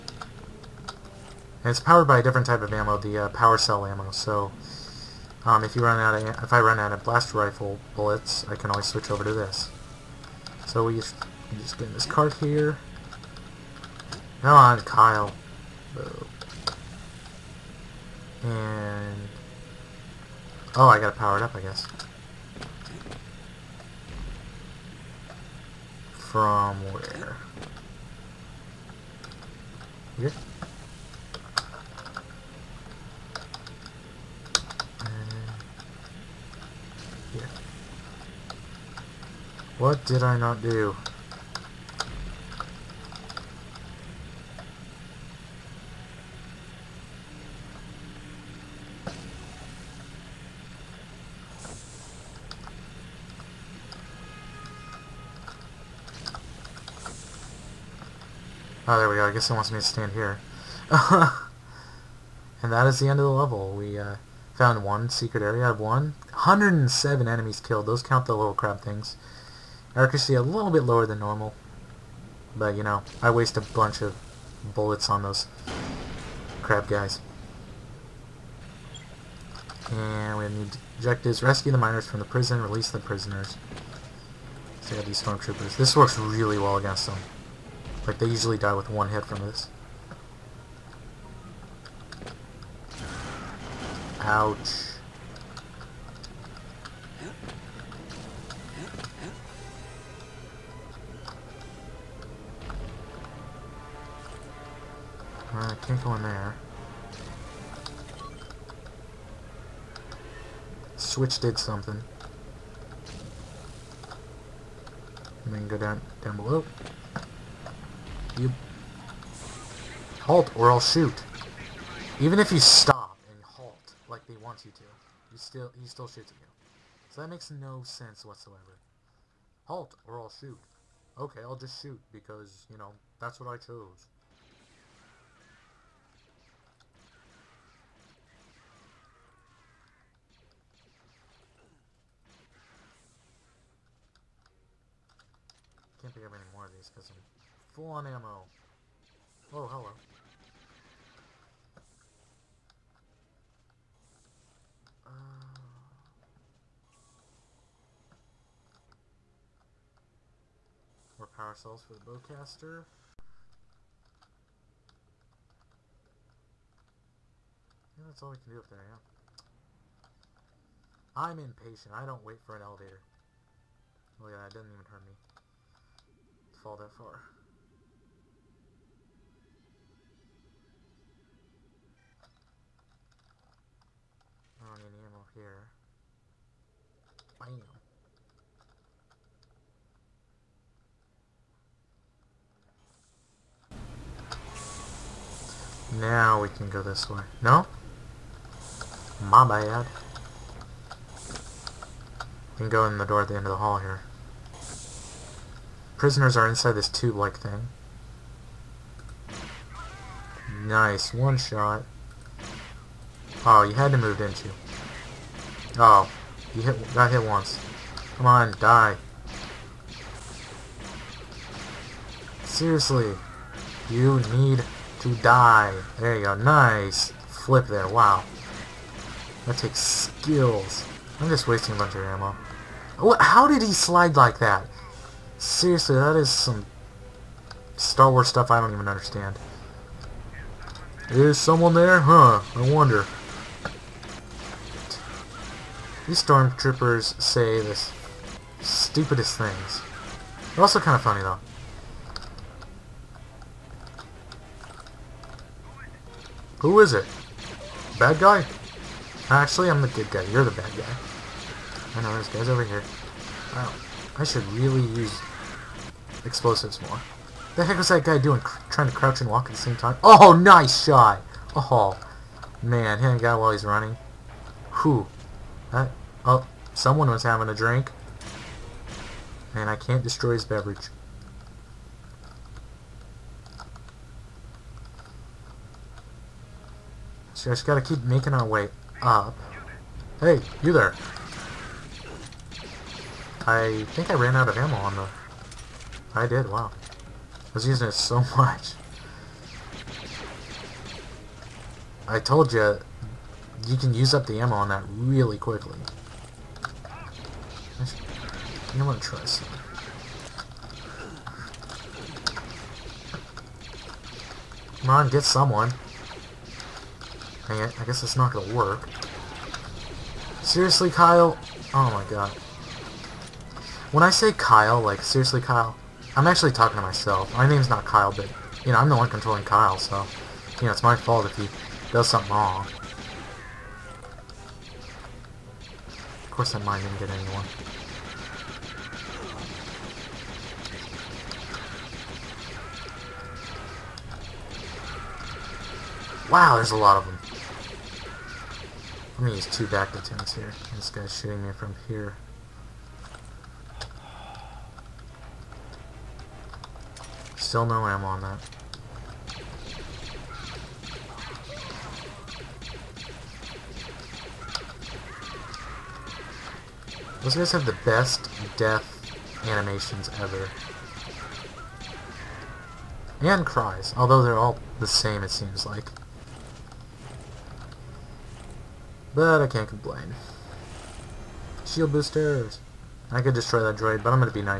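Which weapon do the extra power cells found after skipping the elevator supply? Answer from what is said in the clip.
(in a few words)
The bowcaster.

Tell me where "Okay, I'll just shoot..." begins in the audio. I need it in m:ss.
2:11.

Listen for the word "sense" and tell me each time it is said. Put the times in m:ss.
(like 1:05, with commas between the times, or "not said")
2:07.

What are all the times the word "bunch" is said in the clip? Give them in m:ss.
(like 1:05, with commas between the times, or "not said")
1:13, 3:51.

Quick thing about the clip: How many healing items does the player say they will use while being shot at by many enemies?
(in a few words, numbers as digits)
2 bacta tanks.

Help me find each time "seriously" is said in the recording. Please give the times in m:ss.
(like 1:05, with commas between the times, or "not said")
3:42, 3:55, 5:20, 5:25.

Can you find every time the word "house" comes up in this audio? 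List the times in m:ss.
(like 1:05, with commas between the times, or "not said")
not said.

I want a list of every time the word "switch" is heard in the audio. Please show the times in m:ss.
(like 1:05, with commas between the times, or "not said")
0:08, 1:50.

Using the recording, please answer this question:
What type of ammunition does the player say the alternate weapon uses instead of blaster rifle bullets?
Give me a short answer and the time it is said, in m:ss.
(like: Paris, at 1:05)
Power cell ammo, at 0:03.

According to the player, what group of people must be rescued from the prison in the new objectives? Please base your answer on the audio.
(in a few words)
The miners.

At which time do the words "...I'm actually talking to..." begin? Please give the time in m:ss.
5:26.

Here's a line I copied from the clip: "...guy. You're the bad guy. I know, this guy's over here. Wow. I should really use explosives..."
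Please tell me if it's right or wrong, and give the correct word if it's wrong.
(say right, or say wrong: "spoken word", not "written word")
right.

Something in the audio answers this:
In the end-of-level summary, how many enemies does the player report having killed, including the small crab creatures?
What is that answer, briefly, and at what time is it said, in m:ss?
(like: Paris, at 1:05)
107, at 1:06.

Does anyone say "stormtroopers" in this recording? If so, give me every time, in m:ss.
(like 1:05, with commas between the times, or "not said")
1:25, 4:06.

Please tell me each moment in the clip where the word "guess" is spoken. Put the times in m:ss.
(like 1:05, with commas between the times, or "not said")
0:21, 0:59, 5:17.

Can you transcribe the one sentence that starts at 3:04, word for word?
I don't need any ammo here.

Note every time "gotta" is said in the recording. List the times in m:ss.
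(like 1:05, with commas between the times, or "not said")
0:20, 4:47.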